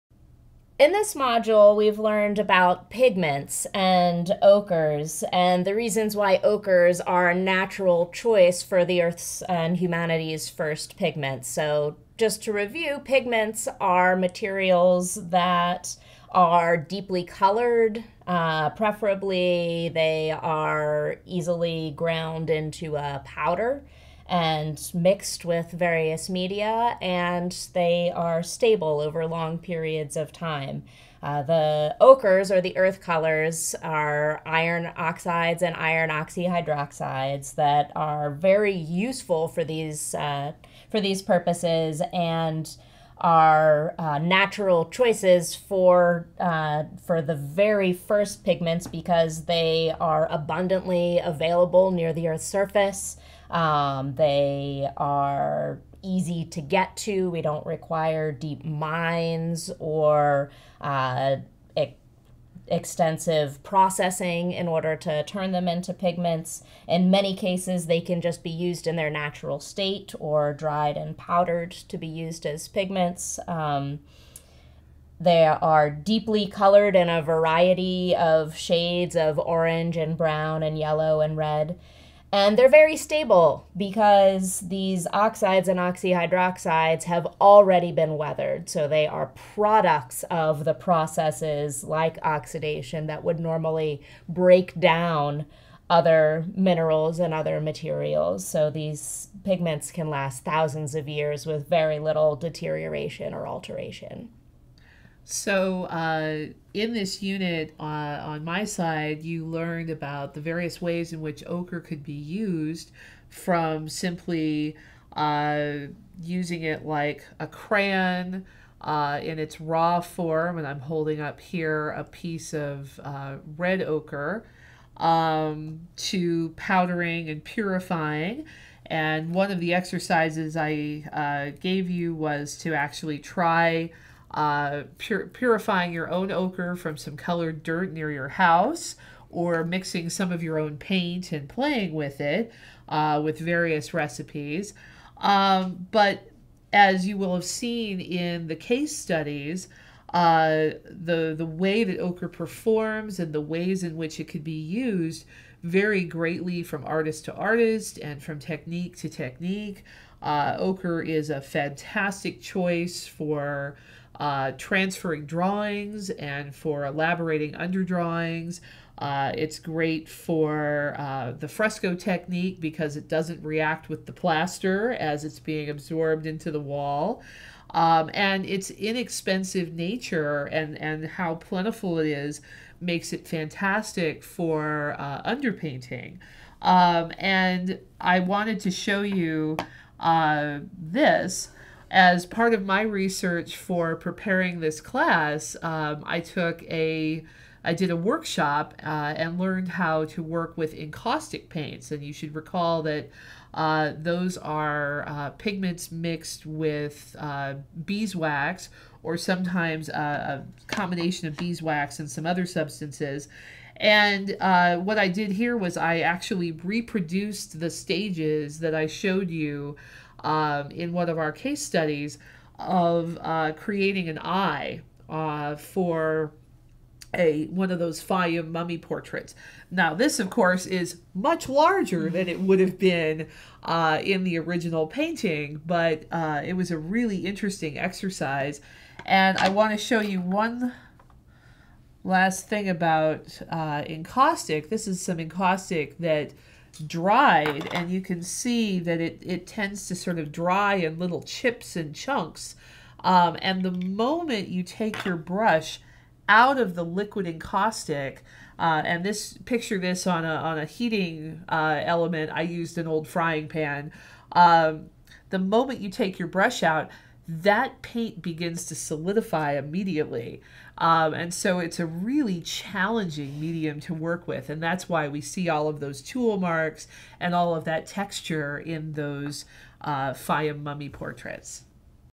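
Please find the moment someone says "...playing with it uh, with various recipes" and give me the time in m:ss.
2:21.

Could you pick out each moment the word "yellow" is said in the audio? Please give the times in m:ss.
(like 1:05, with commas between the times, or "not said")
1:20.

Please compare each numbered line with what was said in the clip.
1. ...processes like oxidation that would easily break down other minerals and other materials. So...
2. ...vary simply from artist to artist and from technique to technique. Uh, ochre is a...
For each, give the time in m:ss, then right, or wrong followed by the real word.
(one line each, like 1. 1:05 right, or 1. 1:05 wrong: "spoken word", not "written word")
1. 1:30 wrong: "normally", not "easily"
2. 2:35 wrong: "greatly", not "simply".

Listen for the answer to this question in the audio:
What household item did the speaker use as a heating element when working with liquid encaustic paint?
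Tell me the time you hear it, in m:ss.
4:22.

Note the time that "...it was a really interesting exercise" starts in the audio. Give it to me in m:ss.
3:56.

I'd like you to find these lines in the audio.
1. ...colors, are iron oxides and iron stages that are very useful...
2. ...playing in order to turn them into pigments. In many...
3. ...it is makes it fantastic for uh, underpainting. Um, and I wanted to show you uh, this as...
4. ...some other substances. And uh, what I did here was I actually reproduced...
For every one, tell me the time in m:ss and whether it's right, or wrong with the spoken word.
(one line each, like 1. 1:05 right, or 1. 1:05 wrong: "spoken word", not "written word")
1. 0:33 wrong: "oxyhydroxides", not "stages"
2. 1:03 wrong: "processing", not "playing"
3. 3:01 right
4. 3:32 right.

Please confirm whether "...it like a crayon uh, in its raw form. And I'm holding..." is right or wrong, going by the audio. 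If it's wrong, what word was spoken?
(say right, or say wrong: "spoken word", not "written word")
right.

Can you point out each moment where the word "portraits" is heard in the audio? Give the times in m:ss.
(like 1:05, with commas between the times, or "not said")
3:48, 4:40.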